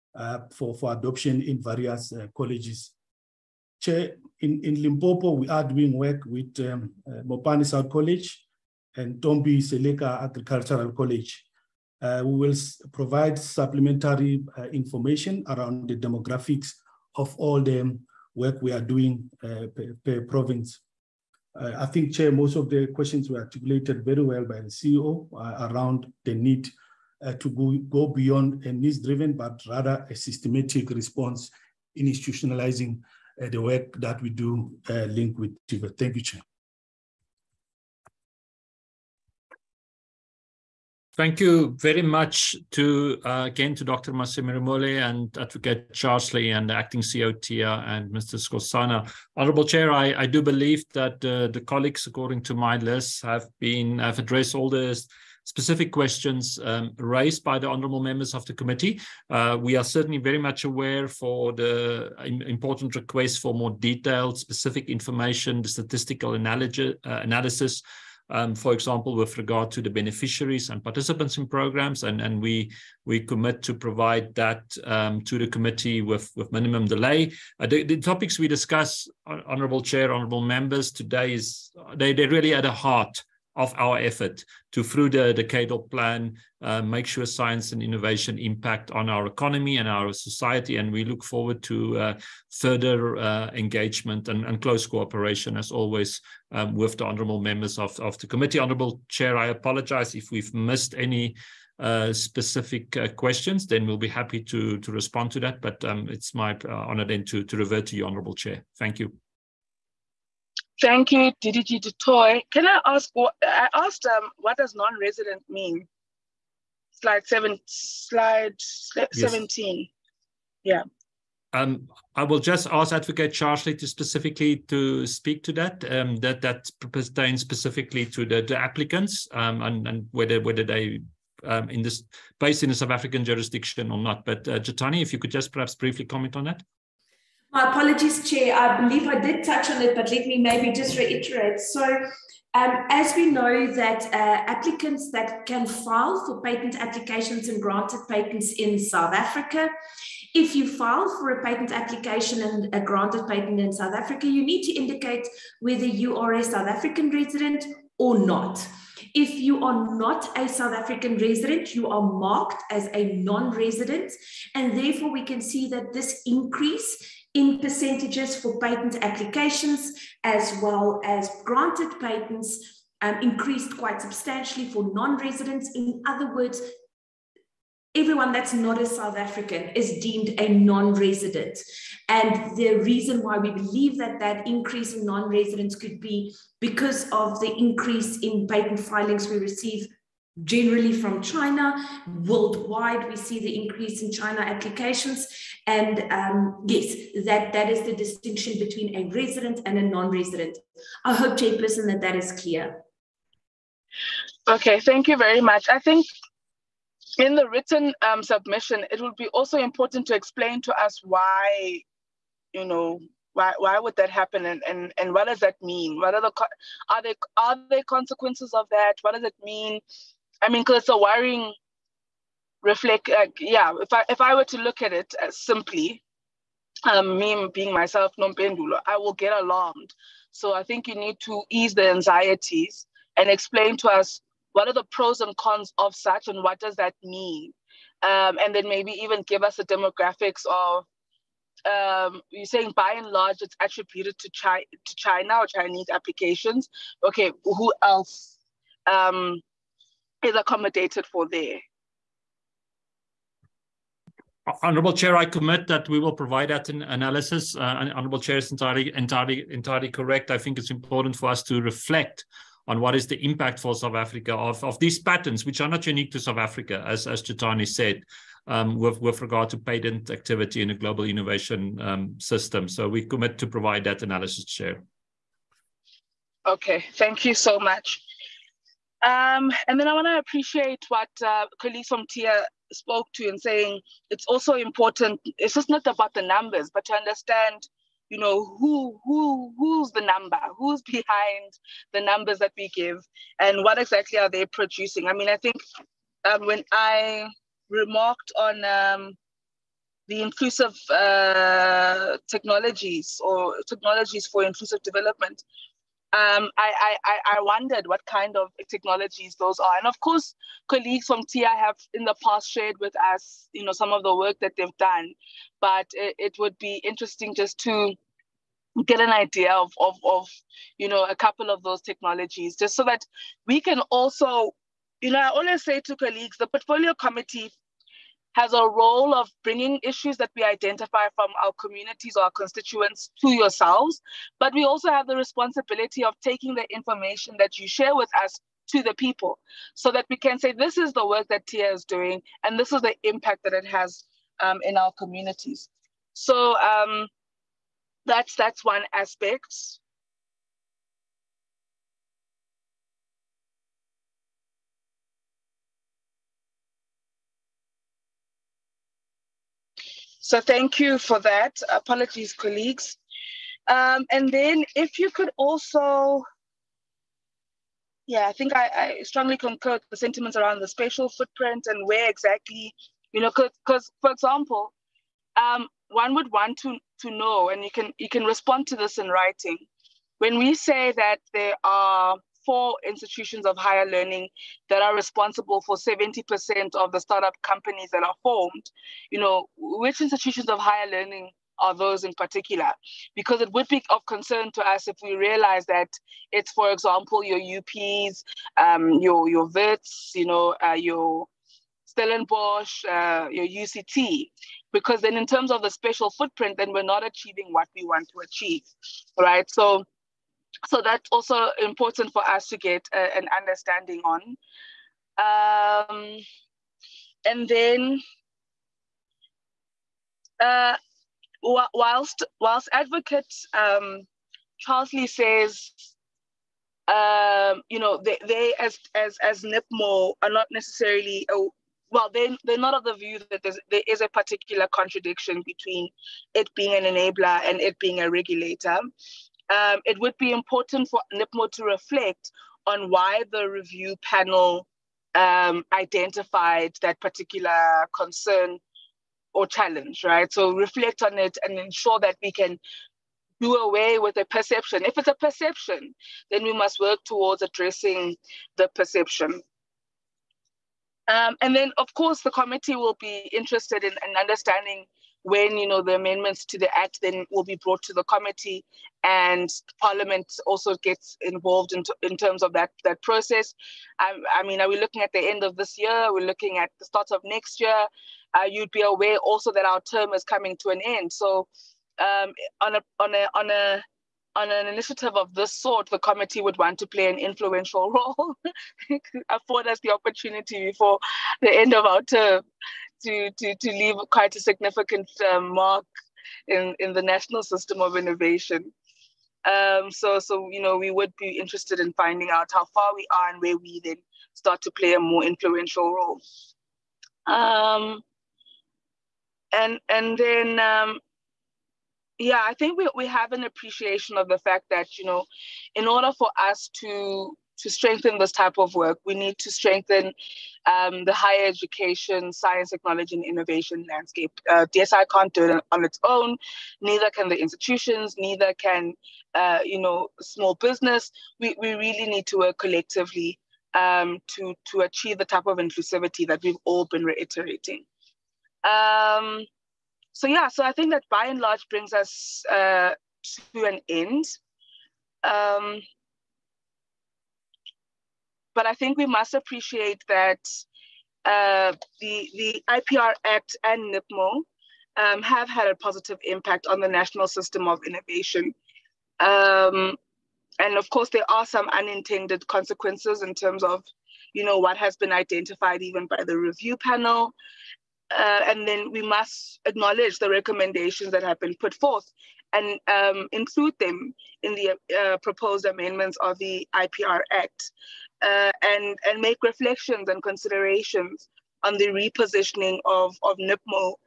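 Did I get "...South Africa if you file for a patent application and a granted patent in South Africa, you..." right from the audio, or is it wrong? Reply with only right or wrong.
right.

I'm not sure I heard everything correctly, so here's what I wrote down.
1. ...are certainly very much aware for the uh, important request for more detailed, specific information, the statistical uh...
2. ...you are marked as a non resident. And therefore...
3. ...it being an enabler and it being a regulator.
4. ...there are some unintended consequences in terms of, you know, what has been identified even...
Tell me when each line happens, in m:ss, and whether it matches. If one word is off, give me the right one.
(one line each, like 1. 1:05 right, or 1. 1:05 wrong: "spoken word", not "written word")
1. 0:59 right
2. 2:41 right
3. 7:16 right
4. 9:21 right.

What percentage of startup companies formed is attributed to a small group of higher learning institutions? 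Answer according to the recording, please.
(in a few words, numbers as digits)
70%.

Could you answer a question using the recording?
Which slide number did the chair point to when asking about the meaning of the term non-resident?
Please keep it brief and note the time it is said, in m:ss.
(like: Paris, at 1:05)
17, at 1:59.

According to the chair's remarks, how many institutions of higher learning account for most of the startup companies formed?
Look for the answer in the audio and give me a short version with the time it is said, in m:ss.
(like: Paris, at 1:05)
4, at 6:22.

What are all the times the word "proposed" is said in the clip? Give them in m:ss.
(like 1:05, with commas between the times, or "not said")
9:35.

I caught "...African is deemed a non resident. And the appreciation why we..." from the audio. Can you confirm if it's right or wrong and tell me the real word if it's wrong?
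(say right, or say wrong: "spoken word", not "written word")
wrong: "reason", not "appreciation".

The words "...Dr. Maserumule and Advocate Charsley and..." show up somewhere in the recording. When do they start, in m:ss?
0:43.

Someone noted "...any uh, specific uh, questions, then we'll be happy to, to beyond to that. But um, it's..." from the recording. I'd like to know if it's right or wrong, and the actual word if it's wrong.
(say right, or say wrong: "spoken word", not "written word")
wrong: "respond", not "beyond".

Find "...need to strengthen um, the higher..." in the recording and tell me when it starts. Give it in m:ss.
8:39.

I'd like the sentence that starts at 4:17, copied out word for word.
Uh, Honorable Chair is entirely, entirely, entirely correct.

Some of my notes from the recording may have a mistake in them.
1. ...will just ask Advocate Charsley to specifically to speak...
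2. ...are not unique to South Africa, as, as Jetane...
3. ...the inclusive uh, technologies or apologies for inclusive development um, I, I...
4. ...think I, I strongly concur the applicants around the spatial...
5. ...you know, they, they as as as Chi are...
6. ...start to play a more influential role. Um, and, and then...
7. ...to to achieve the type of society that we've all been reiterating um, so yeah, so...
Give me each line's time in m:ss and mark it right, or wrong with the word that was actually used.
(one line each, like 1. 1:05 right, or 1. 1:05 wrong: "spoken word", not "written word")
1. 2:02 right
2. 4:25 right
3. 5:00 wrong: "technologies", not "apologies"
4. 6:08 wrong: "sentiments", not "applicants"
5. 7:07 wrong: "NIPMO", not "Chi"
6. 8:24 right
7. 8:54 wrong: "inclusivity", not "society".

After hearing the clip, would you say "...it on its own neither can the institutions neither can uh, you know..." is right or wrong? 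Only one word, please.
right.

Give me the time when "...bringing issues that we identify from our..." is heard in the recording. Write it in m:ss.
5:29.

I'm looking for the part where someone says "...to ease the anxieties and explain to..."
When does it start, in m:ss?
3:51.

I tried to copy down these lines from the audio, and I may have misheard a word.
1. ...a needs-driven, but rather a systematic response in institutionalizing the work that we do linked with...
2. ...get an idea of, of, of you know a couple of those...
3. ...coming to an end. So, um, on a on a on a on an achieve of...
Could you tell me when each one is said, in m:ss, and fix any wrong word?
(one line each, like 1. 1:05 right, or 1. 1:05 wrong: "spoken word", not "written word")
1. 0:28 right
2. 5:18 right
3. 8:00 wrong: "initiative", not "achieve".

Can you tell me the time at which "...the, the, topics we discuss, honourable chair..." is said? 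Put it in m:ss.
1:17.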